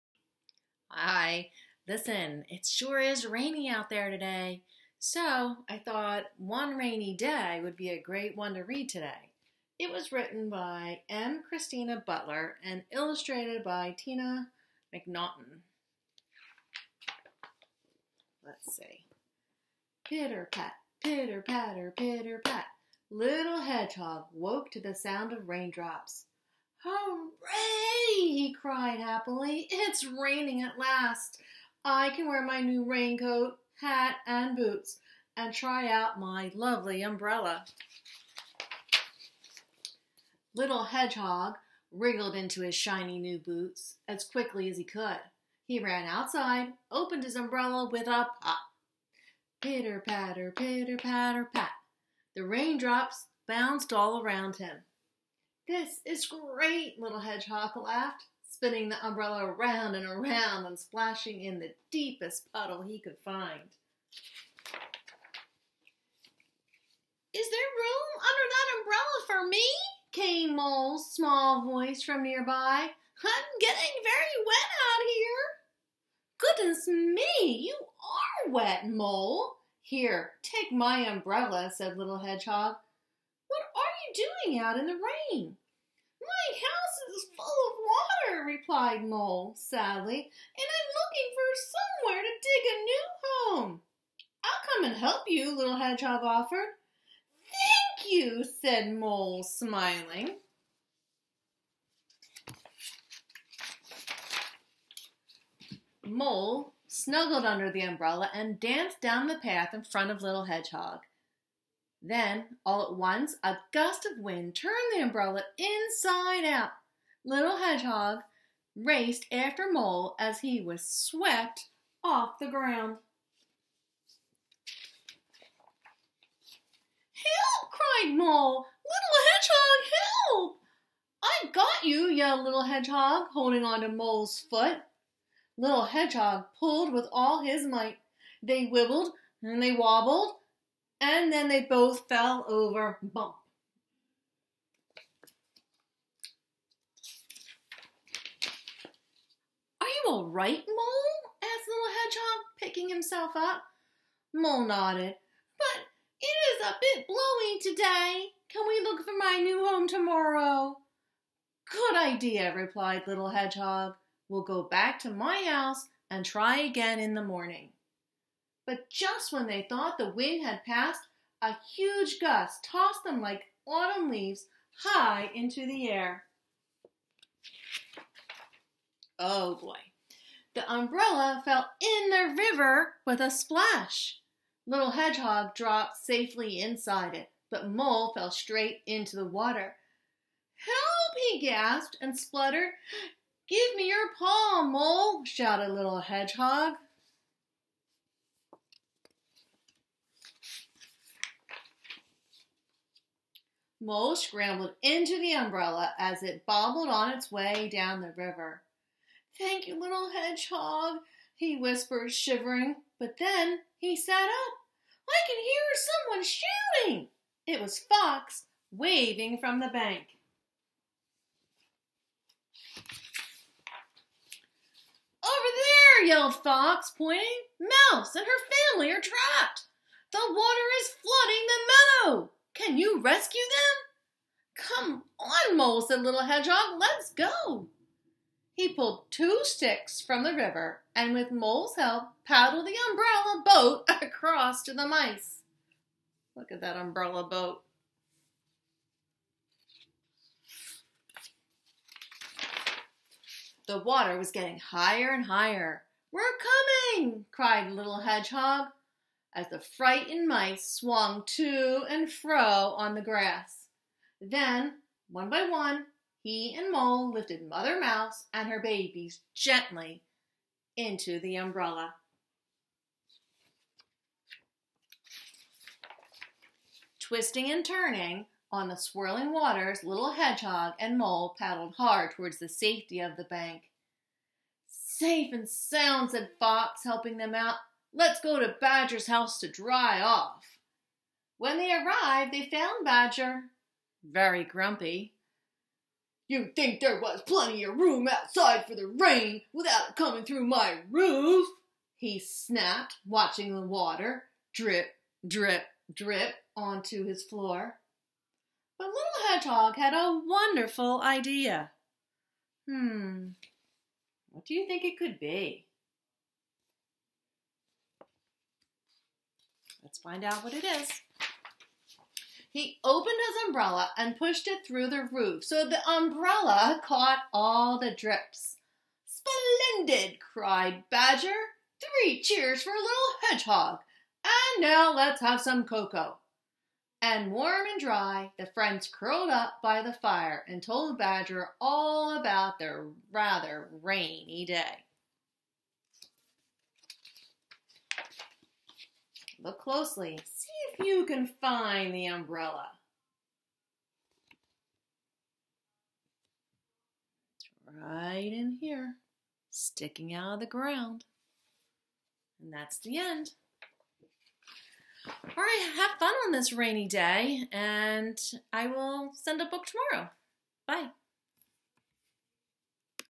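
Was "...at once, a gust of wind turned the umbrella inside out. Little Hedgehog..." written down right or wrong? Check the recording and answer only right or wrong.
right.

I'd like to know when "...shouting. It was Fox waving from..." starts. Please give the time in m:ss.
3:37.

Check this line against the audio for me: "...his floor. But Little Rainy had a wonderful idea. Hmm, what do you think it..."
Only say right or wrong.
wrong.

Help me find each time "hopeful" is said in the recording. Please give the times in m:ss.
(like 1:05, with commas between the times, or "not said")
not said.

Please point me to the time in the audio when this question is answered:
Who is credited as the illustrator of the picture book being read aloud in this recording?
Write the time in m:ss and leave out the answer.
0:13.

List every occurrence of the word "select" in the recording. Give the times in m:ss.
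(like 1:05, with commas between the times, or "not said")
not said.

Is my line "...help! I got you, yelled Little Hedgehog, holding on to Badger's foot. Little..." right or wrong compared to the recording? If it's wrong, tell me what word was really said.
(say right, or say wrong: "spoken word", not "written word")
wrong: "Mole", not "Badger".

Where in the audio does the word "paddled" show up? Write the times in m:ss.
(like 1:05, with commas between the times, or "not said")
4:02, 4:41.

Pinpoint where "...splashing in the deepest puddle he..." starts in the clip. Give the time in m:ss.
1:00.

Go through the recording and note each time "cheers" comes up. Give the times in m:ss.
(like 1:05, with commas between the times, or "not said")
5:32.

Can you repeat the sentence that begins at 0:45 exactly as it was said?
He ran outside, opened his umbrella with a pop.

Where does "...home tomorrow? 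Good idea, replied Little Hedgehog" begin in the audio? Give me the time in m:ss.
2:39.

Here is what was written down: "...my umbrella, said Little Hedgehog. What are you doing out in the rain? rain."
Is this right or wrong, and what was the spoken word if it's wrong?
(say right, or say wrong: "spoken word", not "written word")
right.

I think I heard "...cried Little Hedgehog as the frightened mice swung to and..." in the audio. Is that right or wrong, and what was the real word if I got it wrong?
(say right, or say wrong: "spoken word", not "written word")
right.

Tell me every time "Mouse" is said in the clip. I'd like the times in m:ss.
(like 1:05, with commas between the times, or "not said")
3:47, 4:27.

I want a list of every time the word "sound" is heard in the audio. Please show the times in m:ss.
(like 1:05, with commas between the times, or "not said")
0:24, 4:45.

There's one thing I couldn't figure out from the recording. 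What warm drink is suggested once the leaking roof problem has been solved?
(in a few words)
cocoa.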